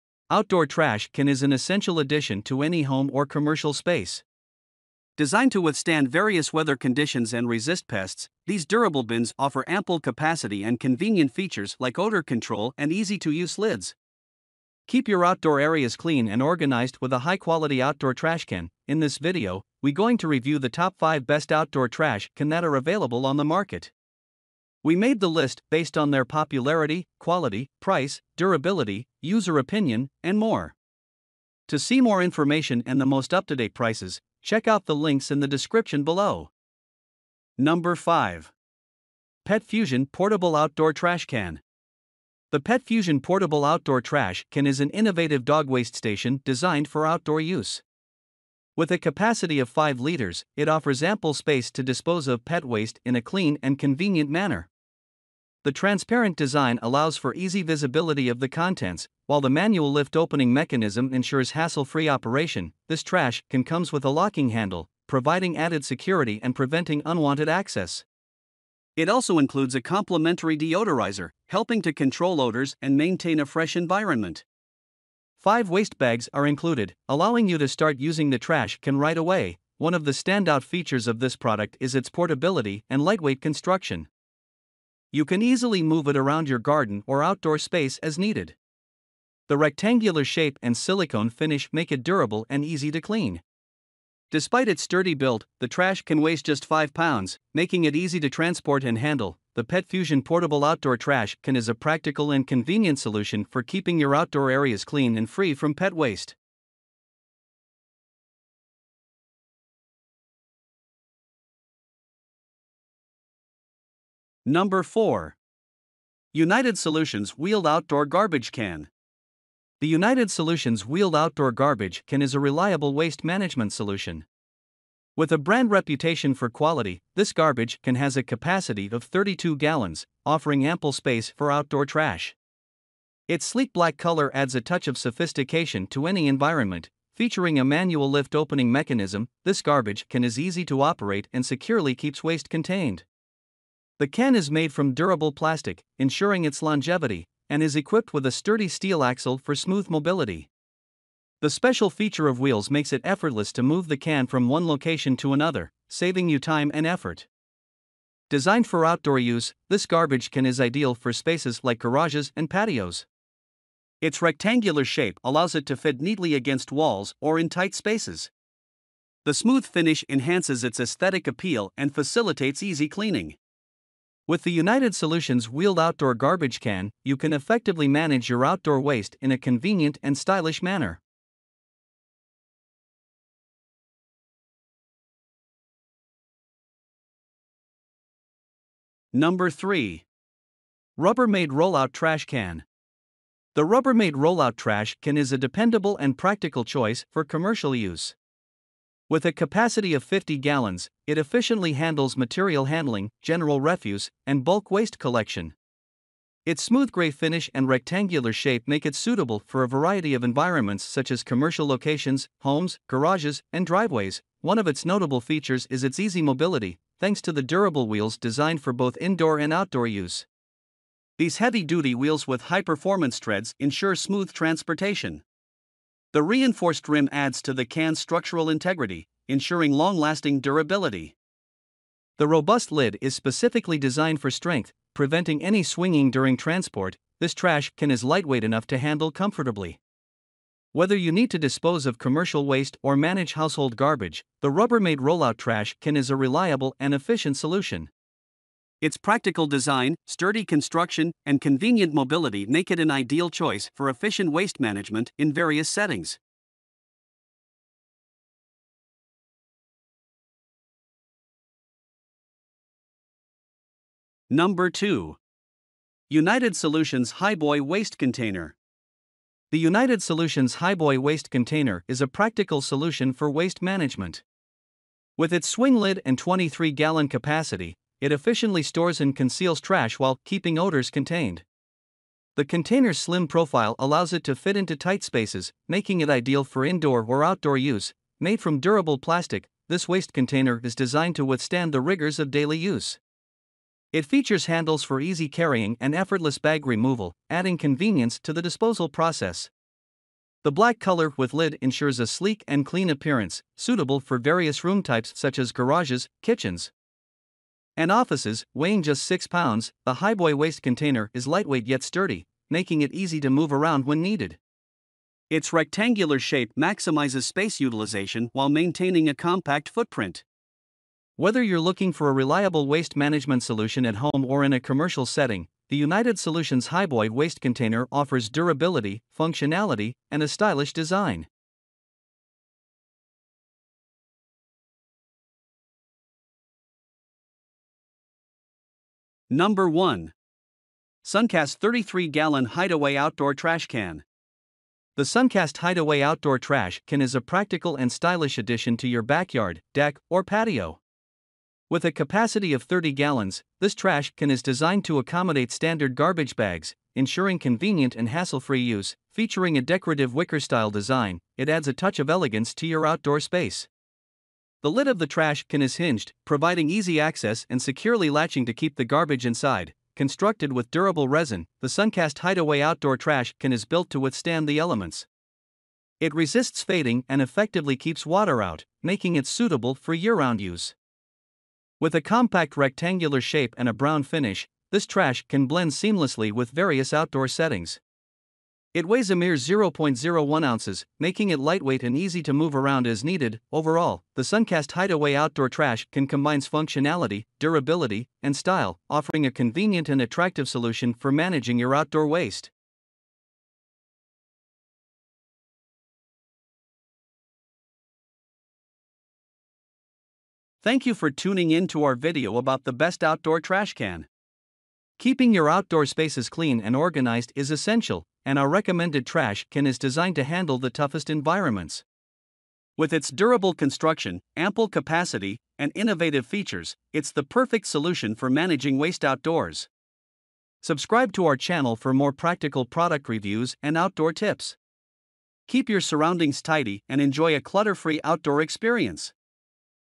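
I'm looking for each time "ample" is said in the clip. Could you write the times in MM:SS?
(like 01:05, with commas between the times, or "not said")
00:09, 00:51, 02:10, 07:04.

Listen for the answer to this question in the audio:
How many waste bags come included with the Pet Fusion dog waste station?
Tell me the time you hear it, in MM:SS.
01:15.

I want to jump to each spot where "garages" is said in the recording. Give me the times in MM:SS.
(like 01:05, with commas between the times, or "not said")
02:41, 03:32, 05:05.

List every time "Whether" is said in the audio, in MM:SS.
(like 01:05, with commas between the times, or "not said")
04:00, 05:21.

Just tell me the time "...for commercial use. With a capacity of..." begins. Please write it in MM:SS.
03:17.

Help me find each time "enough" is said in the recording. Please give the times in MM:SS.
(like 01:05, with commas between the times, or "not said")
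03:58.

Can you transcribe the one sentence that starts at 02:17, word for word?
Featuring a manual lift opening mechanism, this garbage can is easy to operate and securely keeps waste contained.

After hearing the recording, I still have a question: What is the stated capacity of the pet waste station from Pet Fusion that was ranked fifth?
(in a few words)
5 liters.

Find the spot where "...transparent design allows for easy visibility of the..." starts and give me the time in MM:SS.
00:55.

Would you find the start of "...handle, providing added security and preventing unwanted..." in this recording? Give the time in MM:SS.
01:04.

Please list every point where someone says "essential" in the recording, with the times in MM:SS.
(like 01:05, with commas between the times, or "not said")
00:01, 06:57.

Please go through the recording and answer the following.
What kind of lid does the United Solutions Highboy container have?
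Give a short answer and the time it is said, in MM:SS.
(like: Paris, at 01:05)
swing lid, at 04:35.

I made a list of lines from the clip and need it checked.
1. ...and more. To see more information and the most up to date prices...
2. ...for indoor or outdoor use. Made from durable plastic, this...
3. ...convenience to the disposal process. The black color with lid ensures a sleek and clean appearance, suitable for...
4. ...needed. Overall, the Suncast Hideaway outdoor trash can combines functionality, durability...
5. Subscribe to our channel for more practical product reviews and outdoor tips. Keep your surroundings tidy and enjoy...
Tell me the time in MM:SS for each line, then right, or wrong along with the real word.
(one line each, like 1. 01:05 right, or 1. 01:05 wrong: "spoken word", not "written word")
1. 00:30 right
2. 04:46 right
3. 04:57 right
4. 06:33 right
5. 07:10 right.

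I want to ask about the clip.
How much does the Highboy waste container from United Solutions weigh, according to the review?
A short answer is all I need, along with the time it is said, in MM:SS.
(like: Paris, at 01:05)
6 pounds, at 05:09.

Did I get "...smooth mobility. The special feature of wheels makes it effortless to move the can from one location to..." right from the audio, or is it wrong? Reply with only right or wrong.
right.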